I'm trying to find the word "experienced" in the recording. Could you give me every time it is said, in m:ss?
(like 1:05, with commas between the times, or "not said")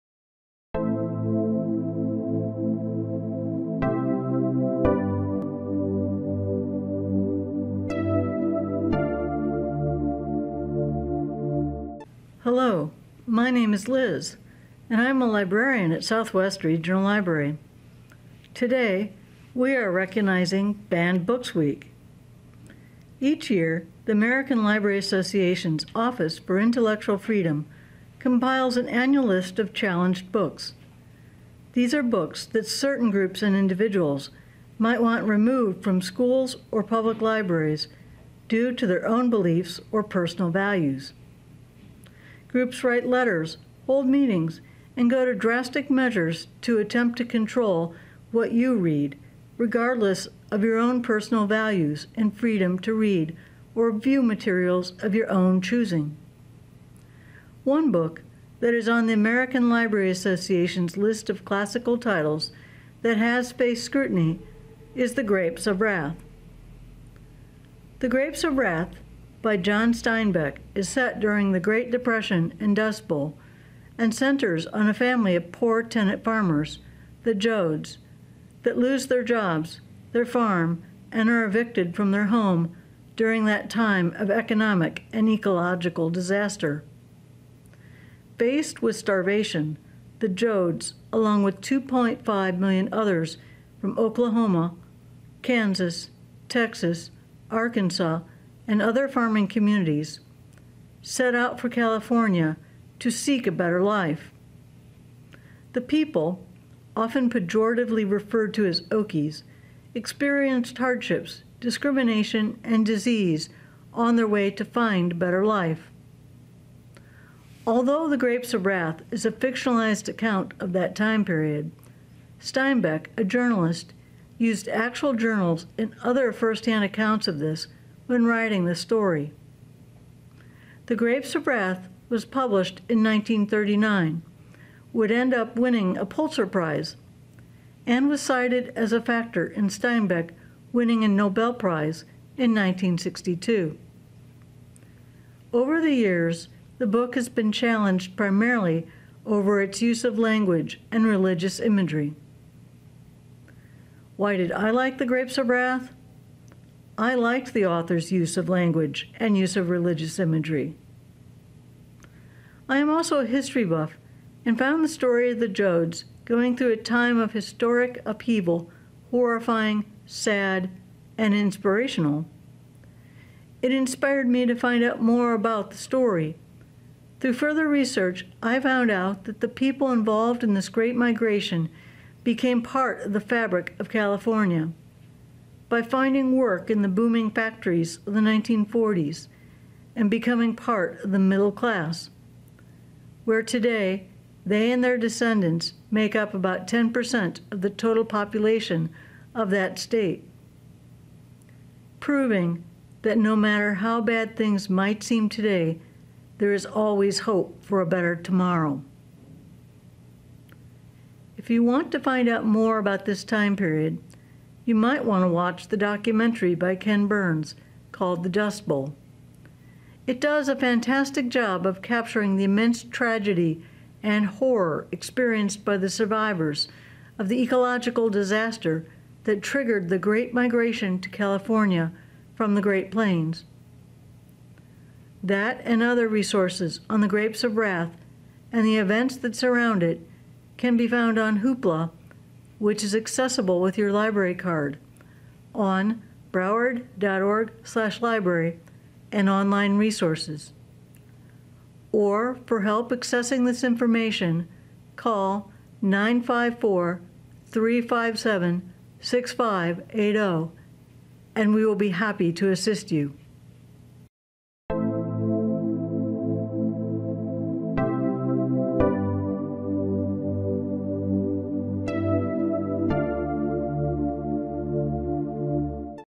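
1:49, 3:44.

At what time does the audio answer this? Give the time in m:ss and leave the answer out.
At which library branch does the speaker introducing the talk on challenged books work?
0:16.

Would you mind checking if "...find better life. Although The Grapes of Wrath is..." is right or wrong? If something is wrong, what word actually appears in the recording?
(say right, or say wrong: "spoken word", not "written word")
right.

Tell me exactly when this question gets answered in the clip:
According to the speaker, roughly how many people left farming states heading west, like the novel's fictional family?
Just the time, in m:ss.
1:31.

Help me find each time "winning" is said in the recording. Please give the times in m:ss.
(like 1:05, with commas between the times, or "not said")
2:15, 2:20.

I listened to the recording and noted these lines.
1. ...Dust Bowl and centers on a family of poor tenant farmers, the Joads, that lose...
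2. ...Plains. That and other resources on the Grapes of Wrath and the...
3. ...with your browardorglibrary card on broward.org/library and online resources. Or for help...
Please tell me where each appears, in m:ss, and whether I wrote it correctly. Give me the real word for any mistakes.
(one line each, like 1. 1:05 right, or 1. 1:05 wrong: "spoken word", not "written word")
1. 1:12 right
2. 3:52 right
3. 4:03 wrong: "library", not "browardorglibrary".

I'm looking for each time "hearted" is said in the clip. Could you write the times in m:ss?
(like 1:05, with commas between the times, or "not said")
not said.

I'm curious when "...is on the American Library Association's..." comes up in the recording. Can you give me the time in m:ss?
0:58.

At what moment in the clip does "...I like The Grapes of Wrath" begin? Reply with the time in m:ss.
2:34.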